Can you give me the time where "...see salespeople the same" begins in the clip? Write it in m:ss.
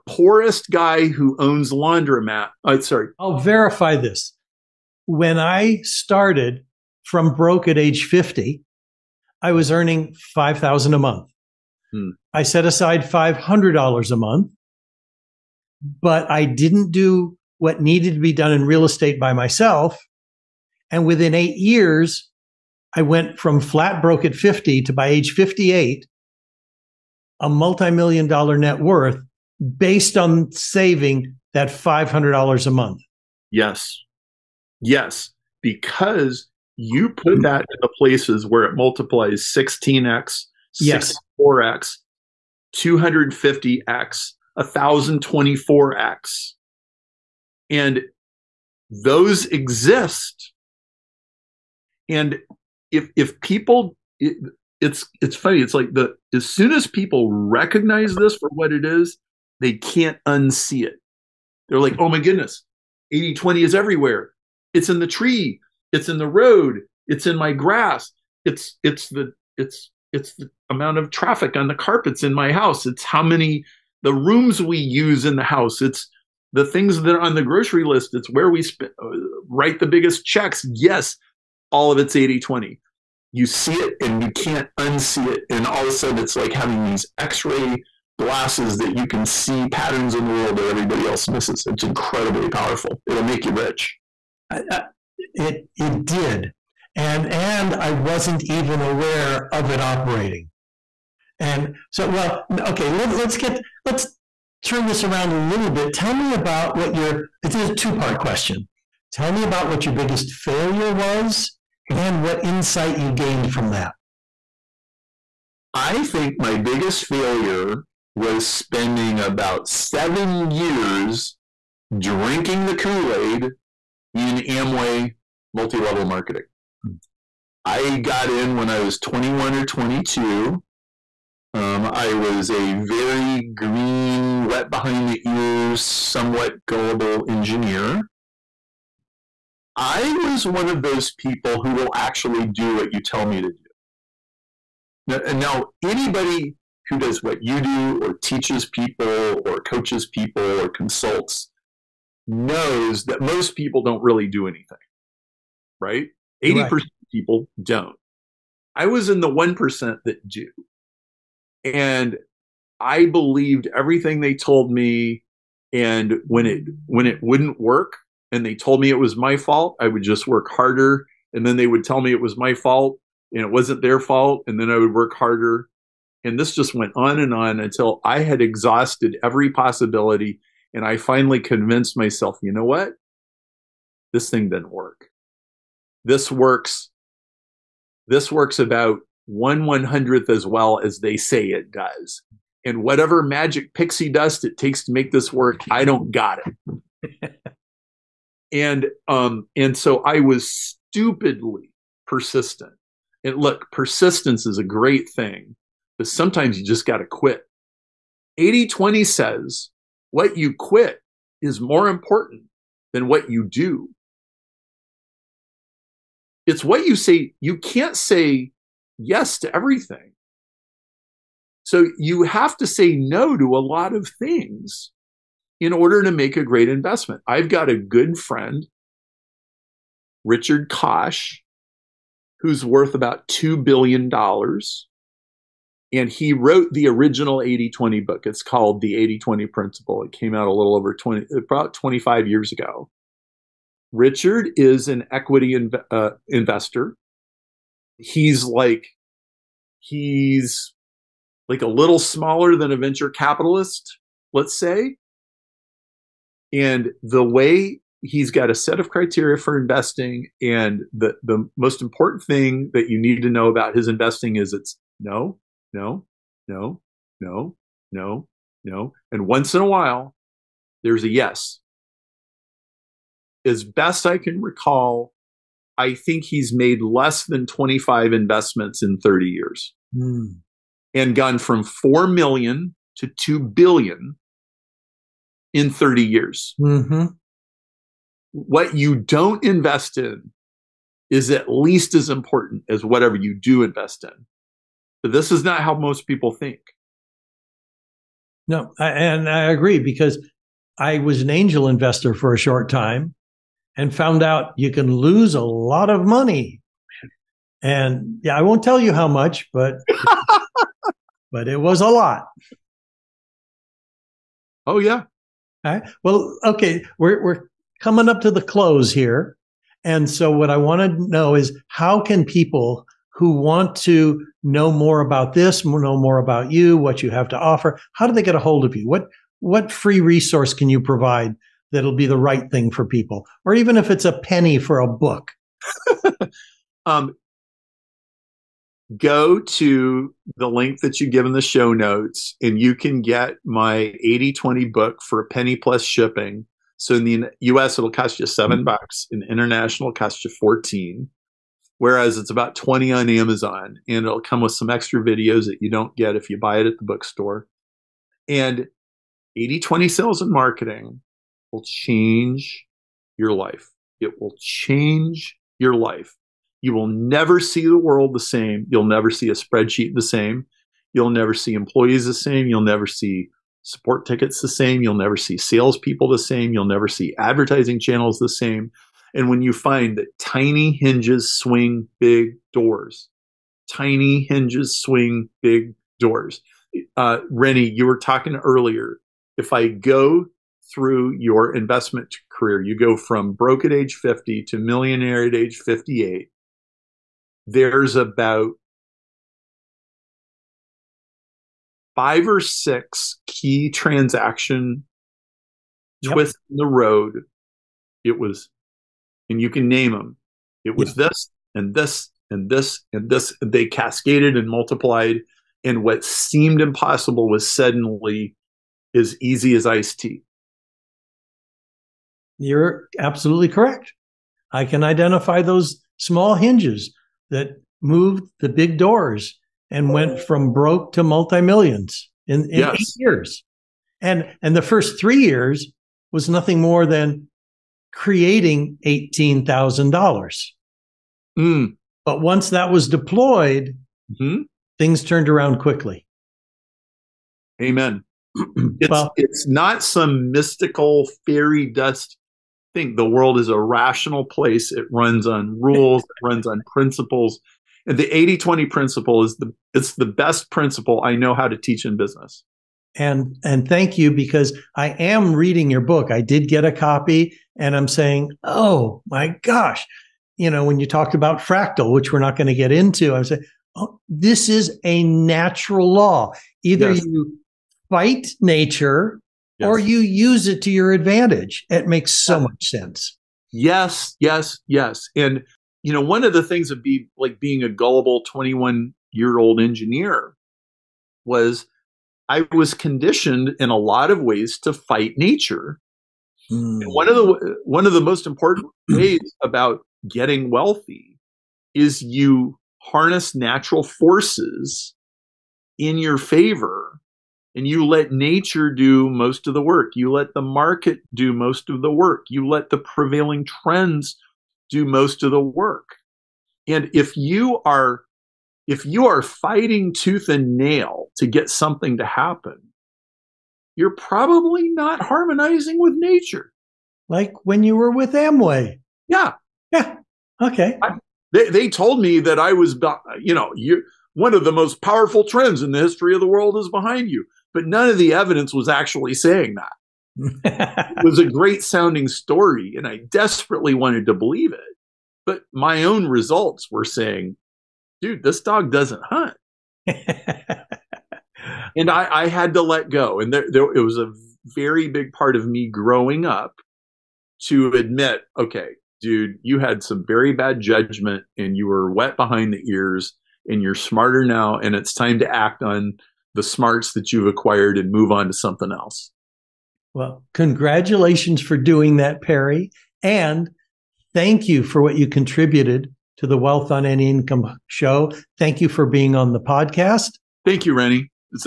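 6:15.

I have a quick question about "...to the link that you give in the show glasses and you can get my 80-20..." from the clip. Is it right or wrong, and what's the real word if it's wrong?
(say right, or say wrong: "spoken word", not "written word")
wrong: "notes", not "glasses".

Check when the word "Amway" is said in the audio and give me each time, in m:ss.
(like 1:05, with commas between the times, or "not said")
2:04, 8:48.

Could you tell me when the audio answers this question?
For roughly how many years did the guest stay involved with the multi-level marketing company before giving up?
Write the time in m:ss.
1:59.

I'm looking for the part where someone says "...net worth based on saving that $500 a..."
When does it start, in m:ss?
0:28.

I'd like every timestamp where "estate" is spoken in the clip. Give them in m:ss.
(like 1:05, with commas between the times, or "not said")
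0:18.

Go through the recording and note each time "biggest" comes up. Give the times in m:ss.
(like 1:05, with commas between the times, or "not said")
1:19, 1:49, 1:56.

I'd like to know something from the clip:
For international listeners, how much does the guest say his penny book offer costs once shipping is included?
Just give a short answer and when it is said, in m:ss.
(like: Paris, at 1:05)
14, at 5:50.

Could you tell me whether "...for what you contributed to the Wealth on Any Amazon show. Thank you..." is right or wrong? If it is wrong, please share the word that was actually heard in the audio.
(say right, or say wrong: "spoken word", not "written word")
wrong: "Income", not "Amazon".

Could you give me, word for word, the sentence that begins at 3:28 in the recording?
80-20 says what you quit is more important than what you do.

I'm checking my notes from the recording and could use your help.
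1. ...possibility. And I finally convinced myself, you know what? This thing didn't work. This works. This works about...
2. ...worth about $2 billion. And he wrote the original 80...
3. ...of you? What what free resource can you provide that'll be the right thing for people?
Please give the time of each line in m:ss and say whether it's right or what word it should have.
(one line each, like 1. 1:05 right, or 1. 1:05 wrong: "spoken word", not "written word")
1. 2:59 right
2. 3:52 right
3. 5:28 right.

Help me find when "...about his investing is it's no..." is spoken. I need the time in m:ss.
4:23.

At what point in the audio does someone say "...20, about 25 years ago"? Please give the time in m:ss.
4:00.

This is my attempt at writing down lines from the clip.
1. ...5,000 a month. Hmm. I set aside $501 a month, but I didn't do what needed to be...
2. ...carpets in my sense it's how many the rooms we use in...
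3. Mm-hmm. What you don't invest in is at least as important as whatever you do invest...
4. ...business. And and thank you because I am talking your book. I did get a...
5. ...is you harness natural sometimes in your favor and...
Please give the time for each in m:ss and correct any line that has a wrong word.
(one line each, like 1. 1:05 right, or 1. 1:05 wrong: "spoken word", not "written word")
1. 0:10 wrong: "500", not "501"
2. 1:11 wrong: "house", not "sense"
3. 4:46 right
4. 7:41 wrong: "reading", not "talking"
5. 8:21 wrong: "forces", not "sometimes".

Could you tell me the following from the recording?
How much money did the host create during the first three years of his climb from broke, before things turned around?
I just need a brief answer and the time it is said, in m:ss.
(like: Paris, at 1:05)
$18,000, at 7:18.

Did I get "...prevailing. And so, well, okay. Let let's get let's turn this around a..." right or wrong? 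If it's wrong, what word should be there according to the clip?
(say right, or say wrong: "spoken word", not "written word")
wrong: "operating", not "prevailing".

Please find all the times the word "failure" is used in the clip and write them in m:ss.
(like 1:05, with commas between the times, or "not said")
1:50, 1:57.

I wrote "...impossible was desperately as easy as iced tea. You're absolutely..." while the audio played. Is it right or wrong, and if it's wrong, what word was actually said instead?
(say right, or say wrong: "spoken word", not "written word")
wrong: "suddenly", not "desperately".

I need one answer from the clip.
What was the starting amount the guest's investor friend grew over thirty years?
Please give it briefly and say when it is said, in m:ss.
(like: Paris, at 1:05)
4 million, at 4:41.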